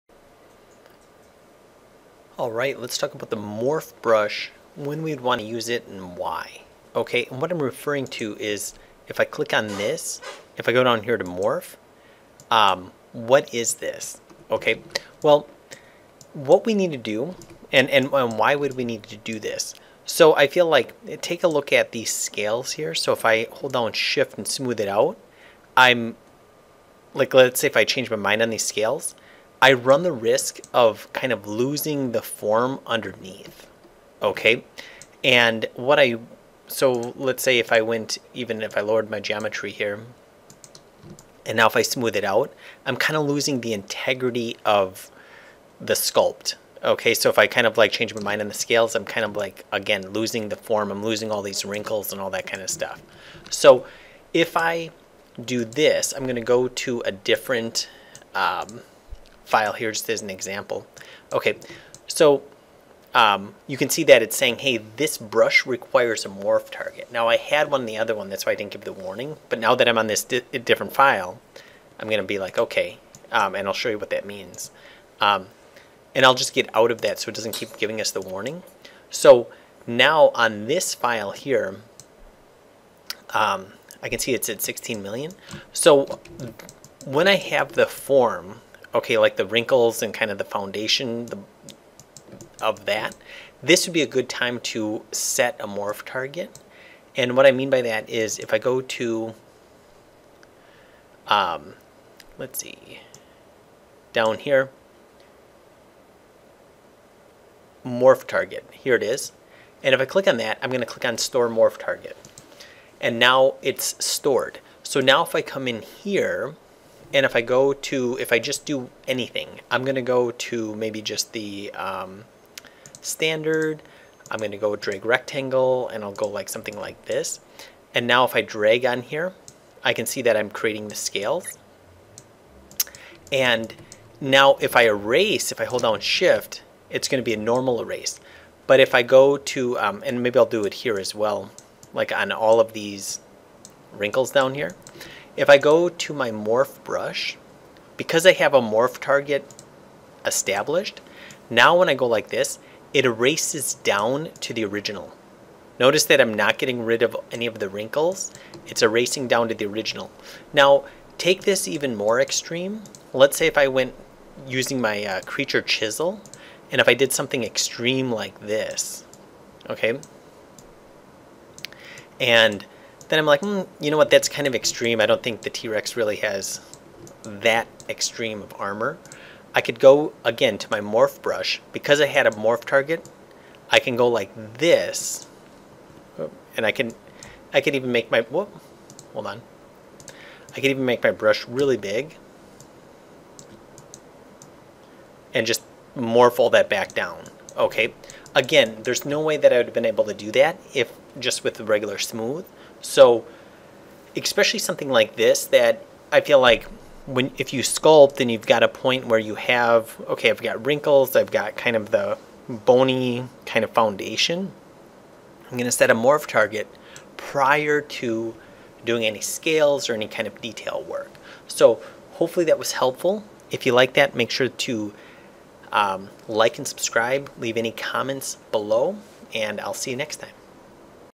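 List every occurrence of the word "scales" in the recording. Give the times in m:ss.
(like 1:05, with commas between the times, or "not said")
0:22, 0:28, 0:48, 2:10, 3:39.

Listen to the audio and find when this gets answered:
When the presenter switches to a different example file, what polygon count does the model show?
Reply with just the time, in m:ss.
1:24.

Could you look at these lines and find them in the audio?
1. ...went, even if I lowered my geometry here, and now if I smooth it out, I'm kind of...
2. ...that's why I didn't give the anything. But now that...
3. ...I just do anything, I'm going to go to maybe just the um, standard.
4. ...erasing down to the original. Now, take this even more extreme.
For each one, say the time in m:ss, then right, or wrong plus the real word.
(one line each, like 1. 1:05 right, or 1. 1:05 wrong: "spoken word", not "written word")
1. 0:37 right
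2. 1:08 wrong: "warning", not "anything"
3. 1:58 right
4. 2:38 right.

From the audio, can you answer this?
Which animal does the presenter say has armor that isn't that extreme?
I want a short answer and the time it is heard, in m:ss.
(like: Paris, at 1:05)
T-Rex, at 2:55.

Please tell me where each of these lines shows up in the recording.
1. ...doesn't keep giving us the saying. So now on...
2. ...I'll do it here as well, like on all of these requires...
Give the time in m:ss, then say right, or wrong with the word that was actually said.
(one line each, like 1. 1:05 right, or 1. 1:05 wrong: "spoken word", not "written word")
1. 1:17 wrong: "warning", not "saying"
2. 2:20 wrong: "wrinkles", not "requires".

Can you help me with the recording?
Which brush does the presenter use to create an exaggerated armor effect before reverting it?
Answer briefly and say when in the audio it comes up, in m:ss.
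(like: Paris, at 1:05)
Creature chisel, at 2:45.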